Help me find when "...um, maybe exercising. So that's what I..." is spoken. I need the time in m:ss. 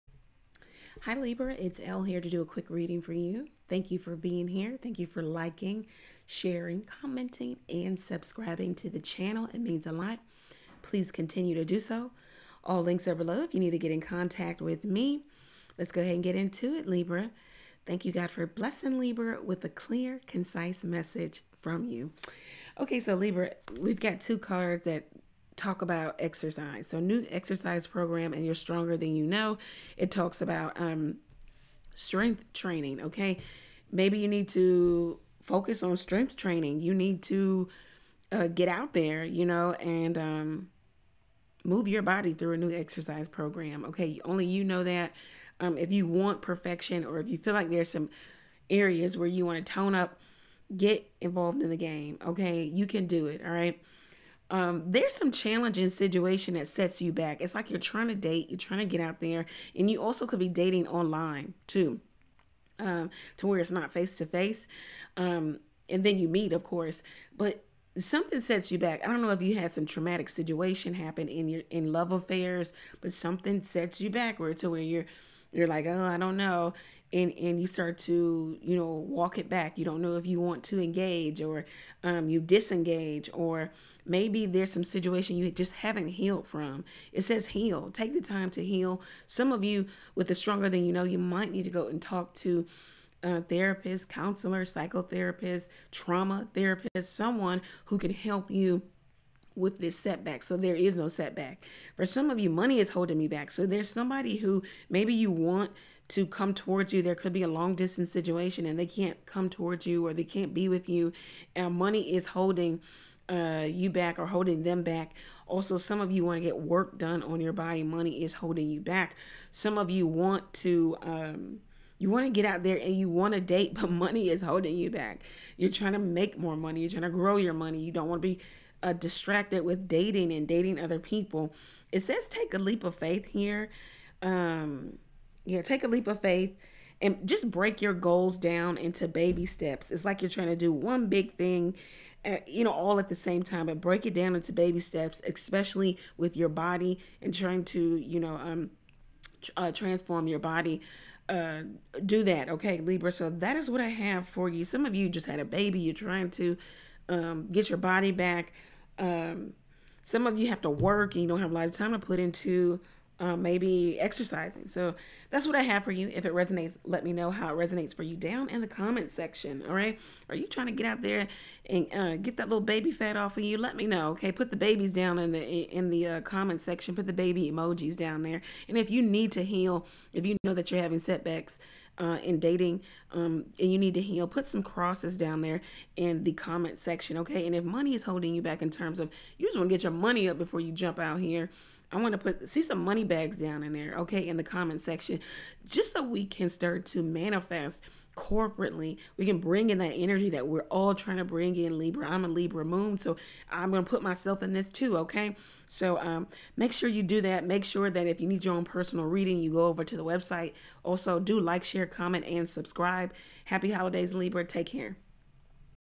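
2:43.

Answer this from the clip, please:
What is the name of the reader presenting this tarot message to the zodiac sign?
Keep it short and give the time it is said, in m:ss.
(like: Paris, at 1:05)
Elle, at 0:01.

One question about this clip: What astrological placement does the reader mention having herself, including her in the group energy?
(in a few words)
Libra moon.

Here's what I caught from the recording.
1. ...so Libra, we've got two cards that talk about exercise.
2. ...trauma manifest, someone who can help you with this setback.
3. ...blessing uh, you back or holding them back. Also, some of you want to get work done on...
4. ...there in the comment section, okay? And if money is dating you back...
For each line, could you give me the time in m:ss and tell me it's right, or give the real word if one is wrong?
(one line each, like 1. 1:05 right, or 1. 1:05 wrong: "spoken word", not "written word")
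1. 0:22 right
2. 1:35 wrong: "therapist", not "manifest"
3. 1:52 wrong: "holding", not "blessing"
4. 3:05 wrong: "holding", not "dating".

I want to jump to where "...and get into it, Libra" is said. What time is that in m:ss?
0:16.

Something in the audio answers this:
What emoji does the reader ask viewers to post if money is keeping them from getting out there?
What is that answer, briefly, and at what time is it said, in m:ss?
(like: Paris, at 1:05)
money bags, at 3:12.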